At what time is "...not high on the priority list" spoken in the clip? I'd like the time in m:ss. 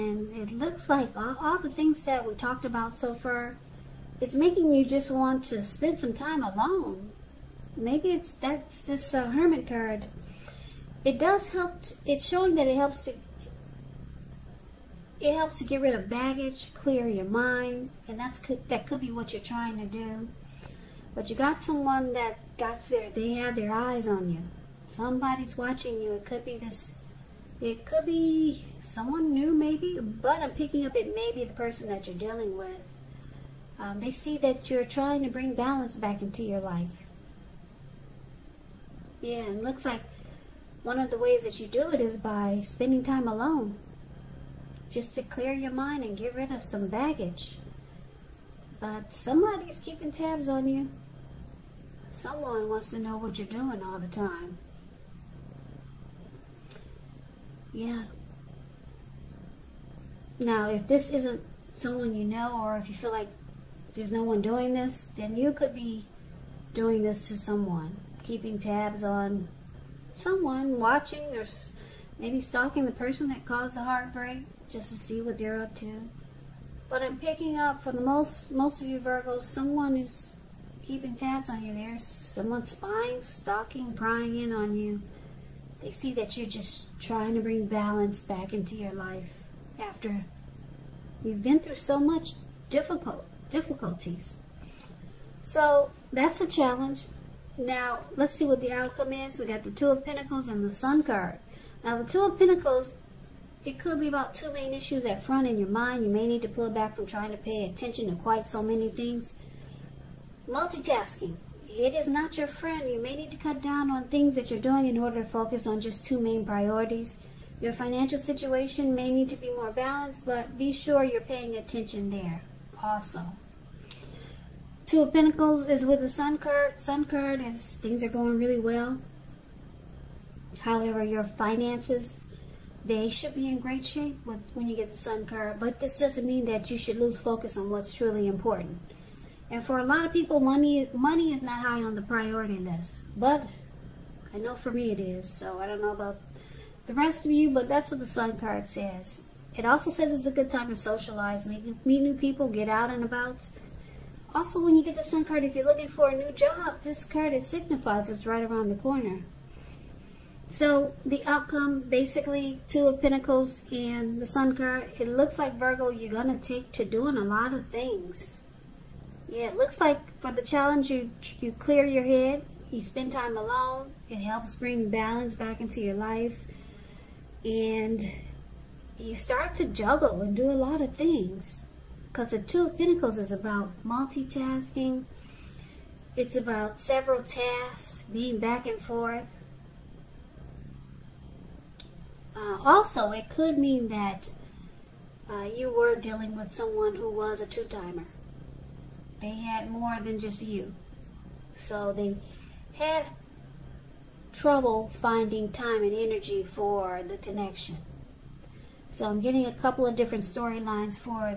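2:21.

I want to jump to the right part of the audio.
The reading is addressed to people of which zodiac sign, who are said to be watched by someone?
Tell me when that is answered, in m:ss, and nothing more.
1:18.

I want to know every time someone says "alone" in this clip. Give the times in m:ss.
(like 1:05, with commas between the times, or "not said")
0:06, 0:43, 2:53.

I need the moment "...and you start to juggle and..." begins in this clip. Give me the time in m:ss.
2:57.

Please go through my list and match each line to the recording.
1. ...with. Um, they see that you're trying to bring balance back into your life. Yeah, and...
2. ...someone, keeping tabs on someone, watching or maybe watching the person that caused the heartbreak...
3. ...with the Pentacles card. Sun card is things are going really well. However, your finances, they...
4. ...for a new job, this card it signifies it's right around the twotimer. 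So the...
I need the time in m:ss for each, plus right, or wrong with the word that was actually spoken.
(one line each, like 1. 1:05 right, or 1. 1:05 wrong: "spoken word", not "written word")
1. 0:32 right
2. 1:07 wrong: "stalking", not "watching"
3. 2:05 wrong: "Sun", not "Pentacles"
4. 2:35 wrong: "corner", not "twotimer".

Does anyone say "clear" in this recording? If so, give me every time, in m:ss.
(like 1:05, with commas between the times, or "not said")
0:16, 0:45, 2:51.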